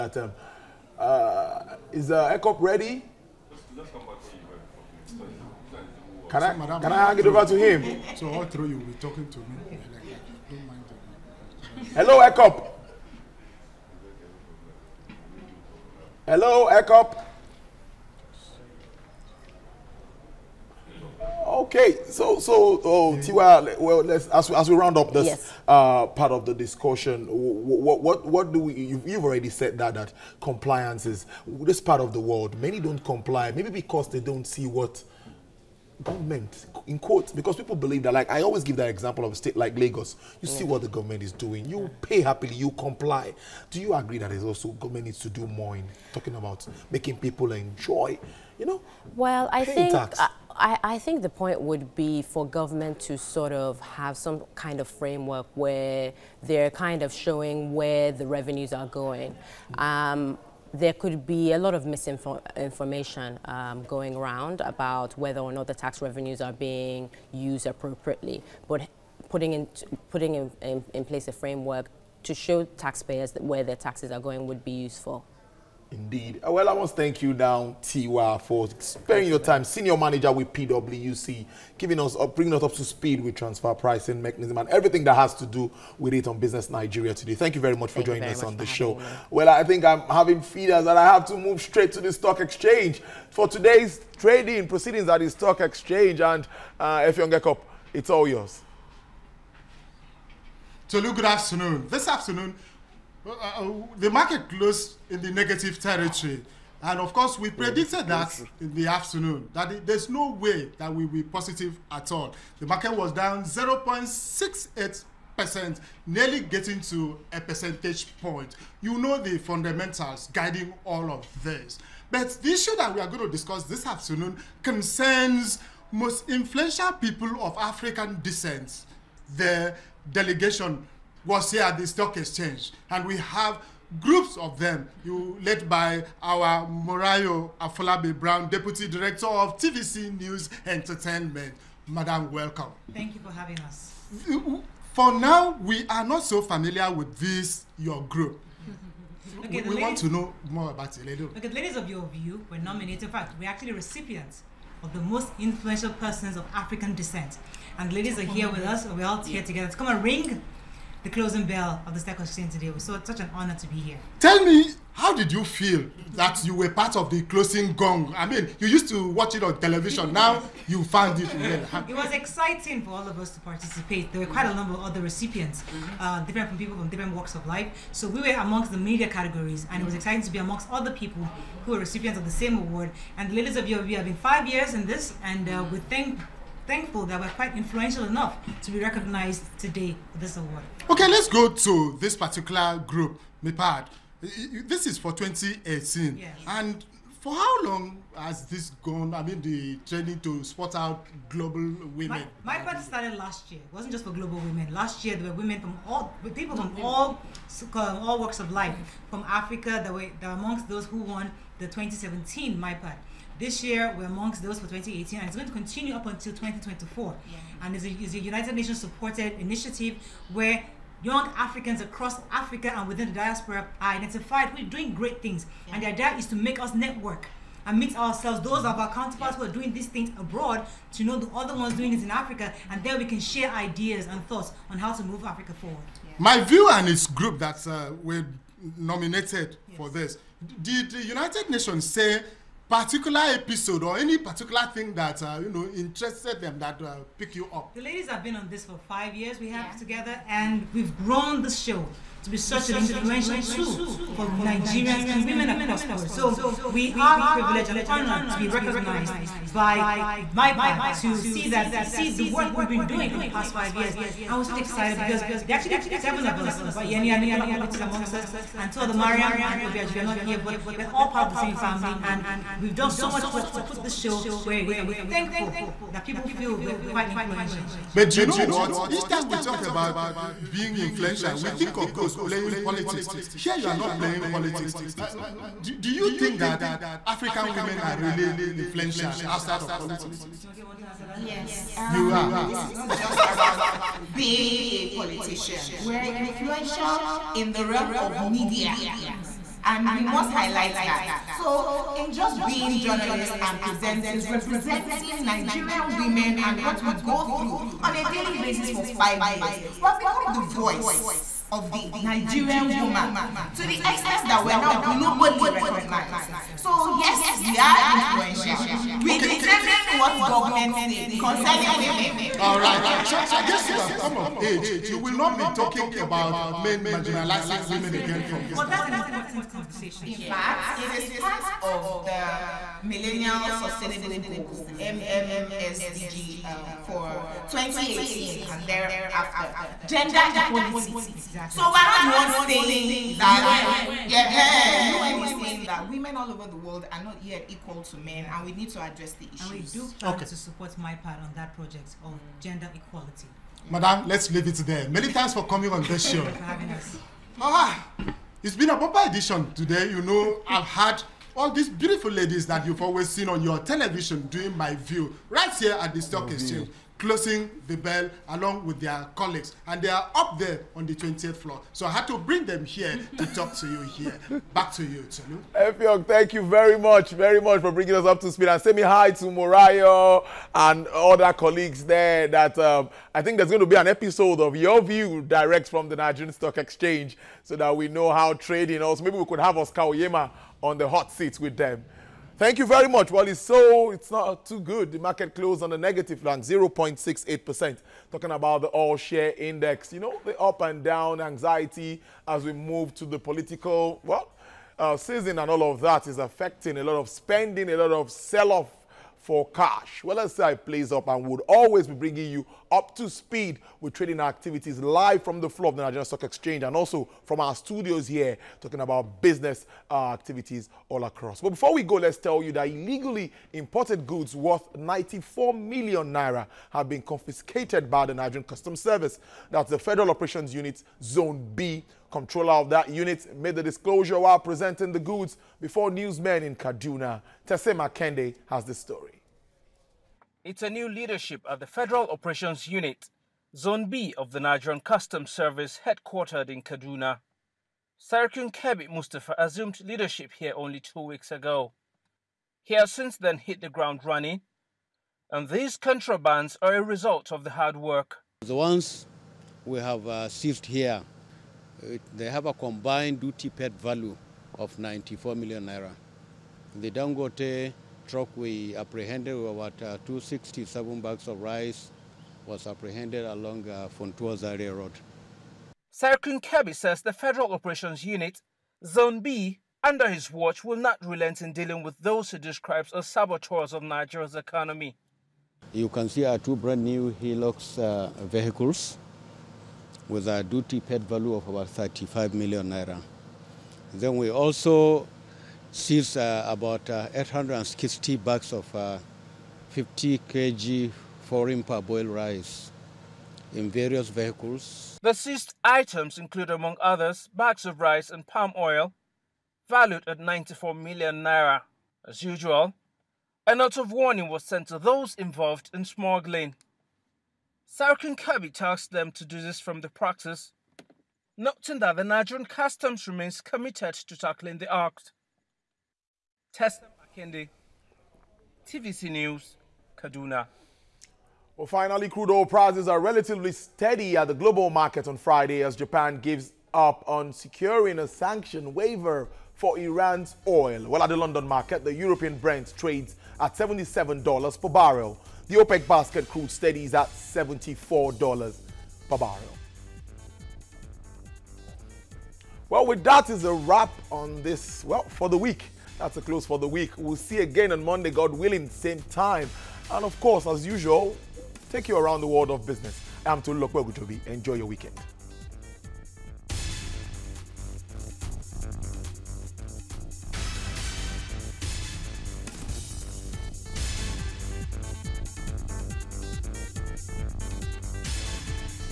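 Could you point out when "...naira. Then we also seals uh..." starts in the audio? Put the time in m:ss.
8:12.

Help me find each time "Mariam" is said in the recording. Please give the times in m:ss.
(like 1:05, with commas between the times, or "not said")
4:28.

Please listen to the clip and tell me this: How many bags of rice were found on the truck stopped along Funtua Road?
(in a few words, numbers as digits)
267.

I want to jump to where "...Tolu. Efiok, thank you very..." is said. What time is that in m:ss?
6:15.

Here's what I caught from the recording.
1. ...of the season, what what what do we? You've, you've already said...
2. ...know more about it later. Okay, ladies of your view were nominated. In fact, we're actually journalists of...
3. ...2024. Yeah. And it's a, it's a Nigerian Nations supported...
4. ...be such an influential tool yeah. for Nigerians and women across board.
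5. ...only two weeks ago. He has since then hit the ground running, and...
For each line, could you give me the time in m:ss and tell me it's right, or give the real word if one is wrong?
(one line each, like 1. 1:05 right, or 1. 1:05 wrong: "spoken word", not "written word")
1. 0:26 wrong: "discussion", not "season"
2. 2:30 wrong: "recipients", not "journalists"
3. 3:36 wrong: "United", not "Nigerian"
4. 4:12 right
5. 7:30 right.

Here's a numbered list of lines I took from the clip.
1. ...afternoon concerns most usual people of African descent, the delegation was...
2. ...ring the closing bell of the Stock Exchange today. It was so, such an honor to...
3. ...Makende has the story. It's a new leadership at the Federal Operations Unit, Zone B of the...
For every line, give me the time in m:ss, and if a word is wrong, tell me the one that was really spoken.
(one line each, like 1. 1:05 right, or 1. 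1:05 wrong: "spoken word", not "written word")
1. 2:03 wrong: "influential", not "usual"
2. 2:40 right
3. 7:17 right.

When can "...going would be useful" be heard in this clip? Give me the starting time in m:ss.
1:14.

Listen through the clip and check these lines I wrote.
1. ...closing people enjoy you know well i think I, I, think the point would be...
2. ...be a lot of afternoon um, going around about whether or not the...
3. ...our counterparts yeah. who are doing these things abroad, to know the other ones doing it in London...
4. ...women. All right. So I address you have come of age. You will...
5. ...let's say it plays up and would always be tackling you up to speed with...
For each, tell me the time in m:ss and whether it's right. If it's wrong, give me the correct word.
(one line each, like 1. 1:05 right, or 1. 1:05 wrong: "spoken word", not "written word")
1. 0:46 wrong: "making", not "closing"
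2. 1:01 wrong: "misinformation", not "afternoon"
3. 3:48 wrong: "Africa", not "London"
4. 5:21 wrong: "guess", not "address"
5. 6:50 wrong: "bringing", not "tackling".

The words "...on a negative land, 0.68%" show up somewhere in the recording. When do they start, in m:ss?
6:35.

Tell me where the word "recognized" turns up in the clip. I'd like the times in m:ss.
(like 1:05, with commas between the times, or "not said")
3:08, 4:18, 5:15.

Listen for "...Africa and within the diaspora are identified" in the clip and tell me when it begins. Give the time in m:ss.
3:42.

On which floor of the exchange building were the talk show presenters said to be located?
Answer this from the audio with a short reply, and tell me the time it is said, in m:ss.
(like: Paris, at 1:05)
20th floor, at 6:10.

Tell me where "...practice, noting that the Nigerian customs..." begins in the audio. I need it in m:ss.
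8:39.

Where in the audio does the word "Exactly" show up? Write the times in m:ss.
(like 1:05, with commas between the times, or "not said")
5:16, 5:41.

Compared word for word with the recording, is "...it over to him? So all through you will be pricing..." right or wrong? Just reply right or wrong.
wrong.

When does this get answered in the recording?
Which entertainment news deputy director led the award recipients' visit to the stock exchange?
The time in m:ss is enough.
2:16.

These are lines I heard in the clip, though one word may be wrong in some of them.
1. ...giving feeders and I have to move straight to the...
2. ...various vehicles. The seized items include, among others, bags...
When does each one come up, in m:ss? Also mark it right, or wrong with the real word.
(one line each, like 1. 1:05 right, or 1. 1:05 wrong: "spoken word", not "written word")
1. 1:30 wrong: "having", not "giving"
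2. 8:23 right.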